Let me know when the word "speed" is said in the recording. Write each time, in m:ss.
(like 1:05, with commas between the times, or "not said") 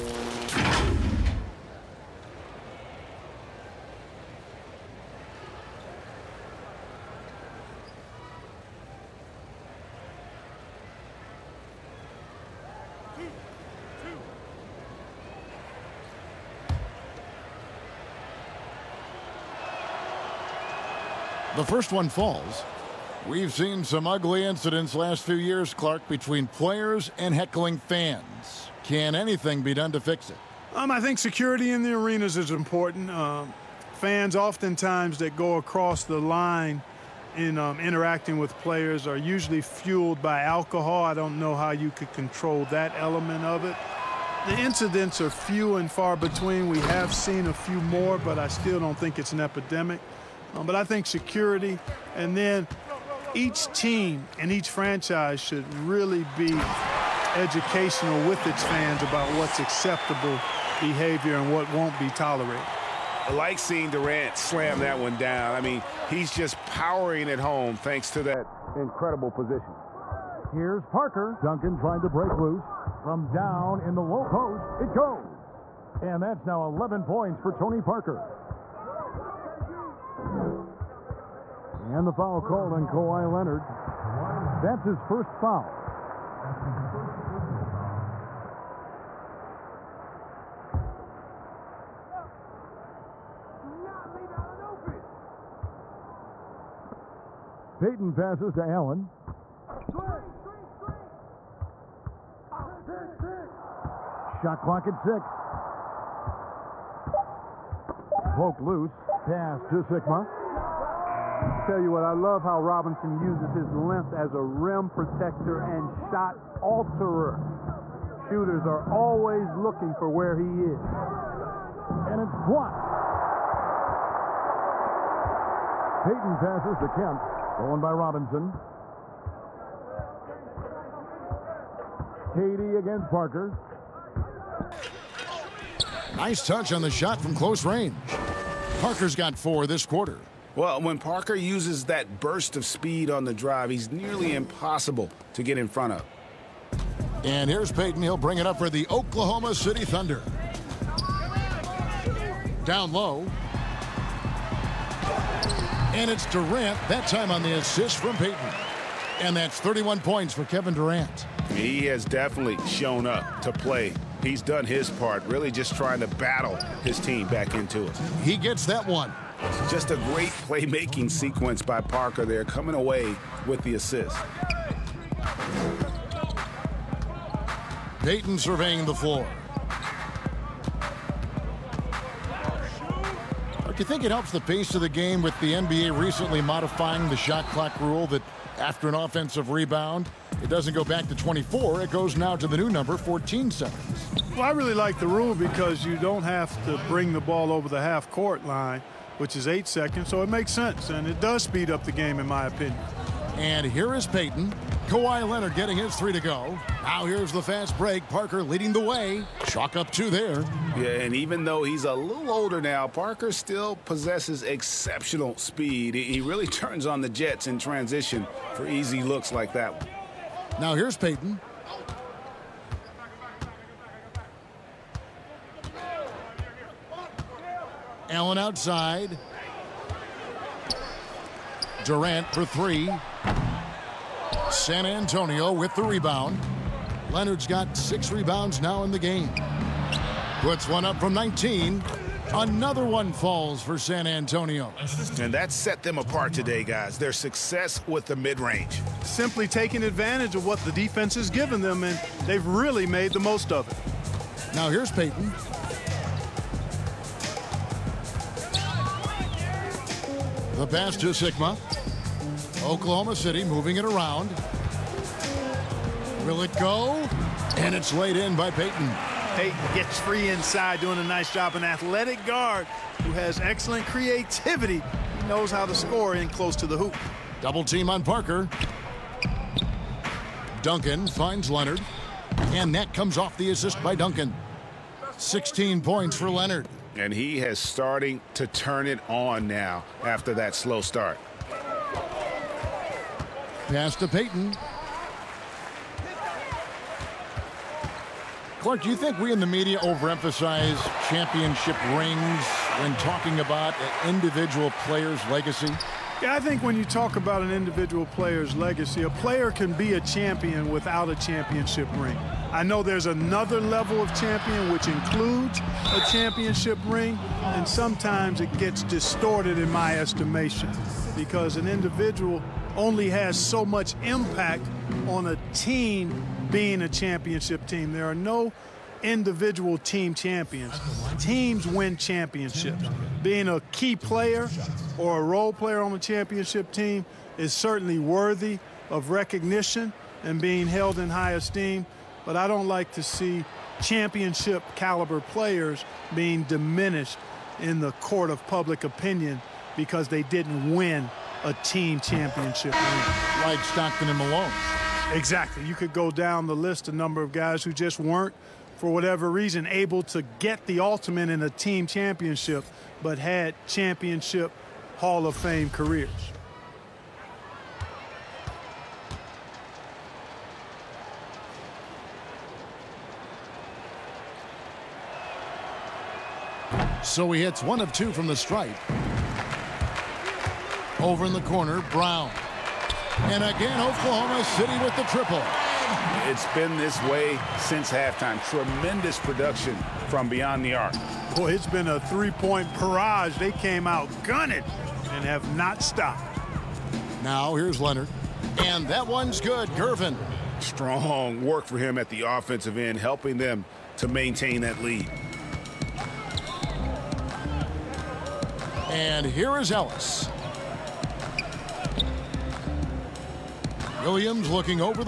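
2:22, 3:21, 3:35.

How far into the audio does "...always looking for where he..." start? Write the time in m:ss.
1:58.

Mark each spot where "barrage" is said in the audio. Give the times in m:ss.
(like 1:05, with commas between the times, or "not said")
6:32.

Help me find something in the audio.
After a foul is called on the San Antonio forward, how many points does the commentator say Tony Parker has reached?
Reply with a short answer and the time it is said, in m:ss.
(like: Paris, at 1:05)
11, at 1:16.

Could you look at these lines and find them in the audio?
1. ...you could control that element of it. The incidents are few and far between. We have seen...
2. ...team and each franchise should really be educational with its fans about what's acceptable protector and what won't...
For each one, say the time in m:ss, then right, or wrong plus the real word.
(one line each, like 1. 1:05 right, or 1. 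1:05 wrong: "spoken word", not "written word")
1. 0:41 right
2. 0:53 wrong: "behavior", not "protector".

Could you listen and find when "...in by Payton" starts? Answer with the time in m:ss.
4:28.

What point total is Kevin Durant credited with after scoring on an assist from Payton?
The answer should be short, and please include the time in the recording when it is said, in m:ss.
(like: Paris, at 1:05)
31, at 2:39.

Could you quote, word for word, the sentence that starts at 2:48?
He gets that one just a great playmaking sequence by Parker there, coming away with the assist.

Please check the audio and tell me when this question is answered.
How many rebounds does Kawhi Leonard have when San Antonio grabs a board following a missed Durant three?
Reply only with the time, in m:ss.
3:57.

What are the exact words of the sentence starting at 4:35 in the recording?
He knows how to score in close to the hoop.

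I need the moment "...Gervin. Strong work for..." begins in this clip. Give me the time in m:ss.
6:39.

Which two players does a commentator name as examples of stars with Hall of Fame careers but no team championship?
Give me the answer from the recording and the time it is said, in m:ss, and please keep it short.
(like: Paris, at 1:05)
Stockton and Malone, at 5:53.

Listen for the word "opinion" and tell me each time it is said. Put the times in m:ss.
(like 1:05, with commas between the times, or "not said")
3:22, 5:48.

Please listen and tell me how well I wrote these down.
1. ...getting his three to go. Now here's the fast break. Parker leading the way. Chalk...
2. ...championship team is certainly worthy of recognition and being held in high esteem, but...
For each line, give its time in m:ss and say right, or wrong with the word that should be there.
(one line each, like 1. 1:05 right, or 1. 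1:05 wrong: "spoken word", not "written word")
1. 3:25 right
2. 5:35 right.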